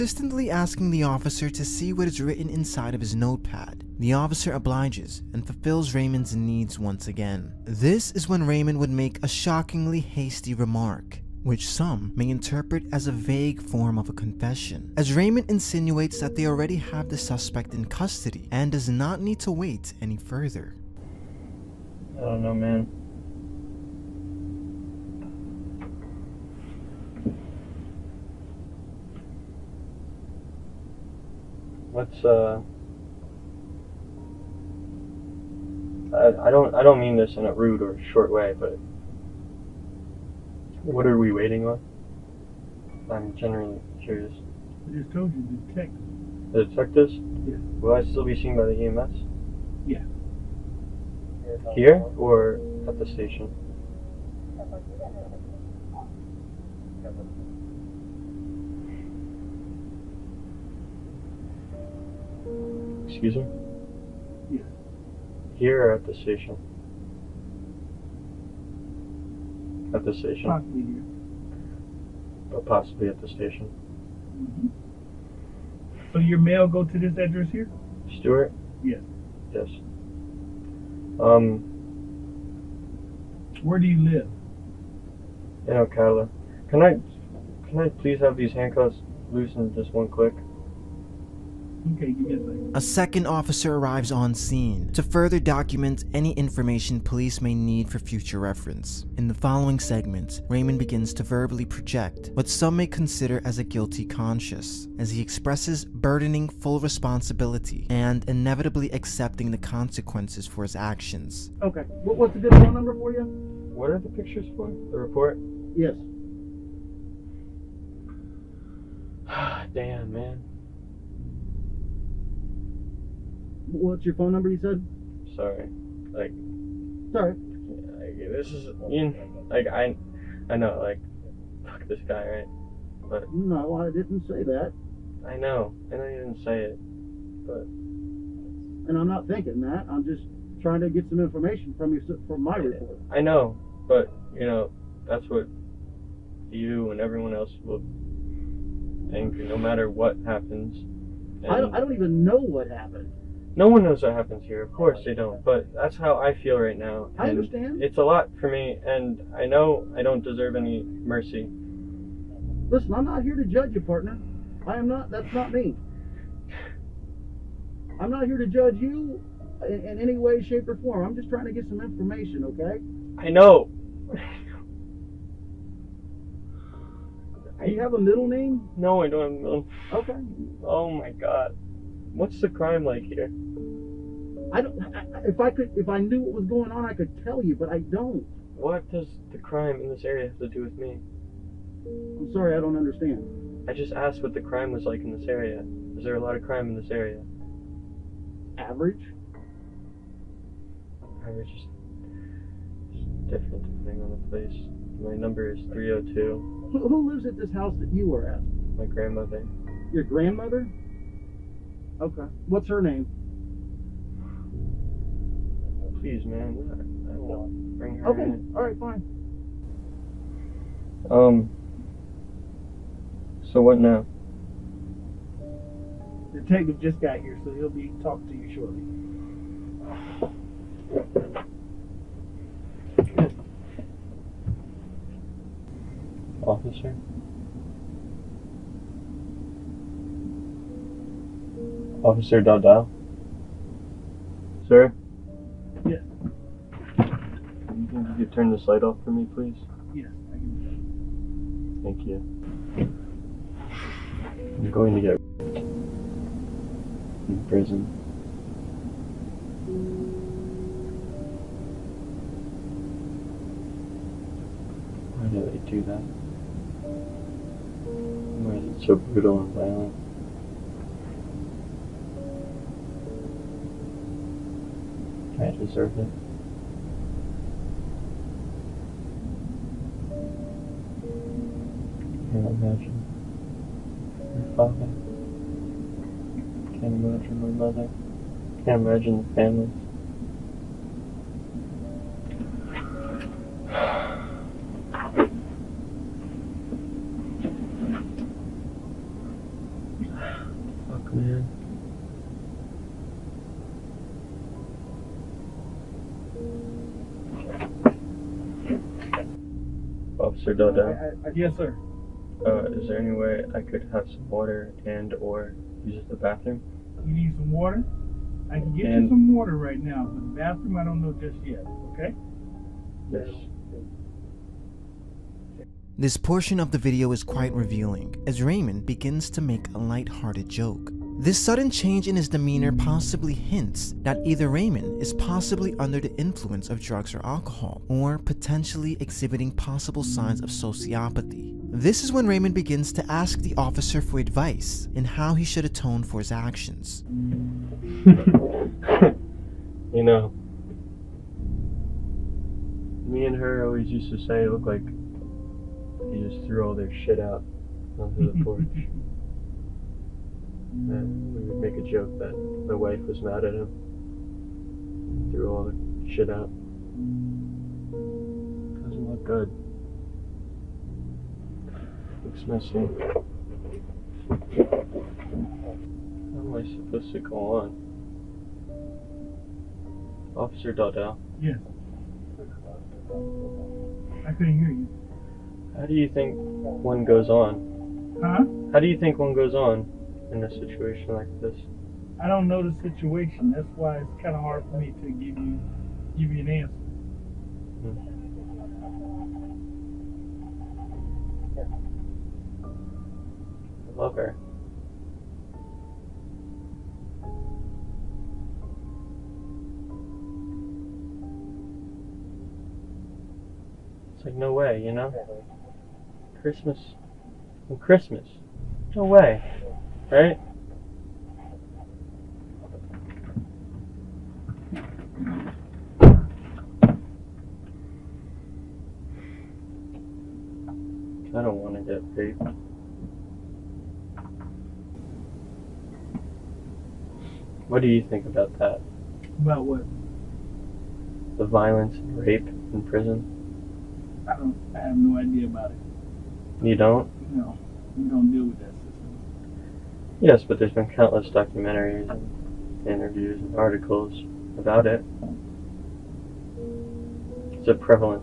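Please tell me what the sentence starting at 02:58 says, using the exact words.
No, I don't have a middle.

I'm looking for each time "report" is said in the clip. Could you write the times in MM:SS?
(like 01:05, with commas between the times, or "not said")
01:54, 02:22.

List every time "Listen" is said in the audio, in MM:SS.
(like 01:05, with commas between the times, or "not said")
02:42.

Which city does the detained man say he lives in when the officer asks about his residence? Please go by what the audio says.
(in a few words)
Ocala.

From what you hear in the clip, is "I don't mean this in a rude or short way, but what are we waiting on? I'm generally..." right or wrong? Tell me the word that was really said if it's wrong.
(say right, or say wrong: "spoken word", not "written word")
right.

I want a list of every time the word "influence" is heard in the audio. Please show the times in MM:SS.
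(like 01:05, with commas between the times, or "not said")
05:36.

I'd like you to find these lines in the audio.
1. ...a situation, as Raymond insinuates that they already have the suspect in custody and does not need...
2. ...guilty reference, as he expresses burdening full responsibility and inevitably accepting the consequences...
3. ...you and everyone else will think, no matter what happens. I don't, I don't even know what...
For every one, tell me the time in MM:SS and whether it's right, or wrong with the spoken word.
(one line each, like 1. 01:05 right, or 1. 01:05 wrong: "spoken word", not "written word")
1. 00:14 wrong: "confession", not "situation"
2. 01:43 wrong: "conscience", not "reference"
3. 02:26 right.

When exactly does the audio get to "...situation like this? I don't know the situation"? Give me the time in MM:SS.
06:30.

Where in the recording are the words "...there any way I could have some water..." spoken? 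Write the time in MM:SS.
05:12.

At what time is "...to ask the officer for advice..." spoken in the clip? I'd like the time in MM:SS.
05:42.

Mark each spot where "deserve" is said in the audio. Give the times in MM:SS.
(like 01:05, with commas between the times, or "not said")
02:40, 04:35.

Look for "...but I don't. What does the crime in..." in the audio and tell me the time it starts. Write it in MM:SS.
03:07.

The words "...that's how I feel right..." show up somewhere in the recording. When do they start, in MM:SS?
02:35.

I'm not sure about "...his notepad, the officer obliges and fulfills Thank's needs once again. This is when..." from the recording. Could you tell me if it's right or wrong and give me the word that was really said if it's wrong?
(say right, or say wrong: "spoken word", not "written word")
wrong: "Raymond", not "Thank".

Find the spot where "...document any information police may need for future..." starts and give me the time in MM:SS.
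01:35.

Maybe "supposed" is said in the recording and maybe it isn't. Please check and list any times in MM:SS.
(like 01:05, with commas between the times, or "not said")
06:16.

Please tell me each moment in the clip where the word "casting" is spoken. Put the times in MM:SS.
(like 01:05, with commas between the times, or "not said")
not said.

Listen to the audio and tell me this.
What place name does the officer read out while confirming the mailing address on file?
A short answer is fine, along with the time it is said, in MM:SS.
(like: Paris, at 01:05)
Stuart, at 01:18.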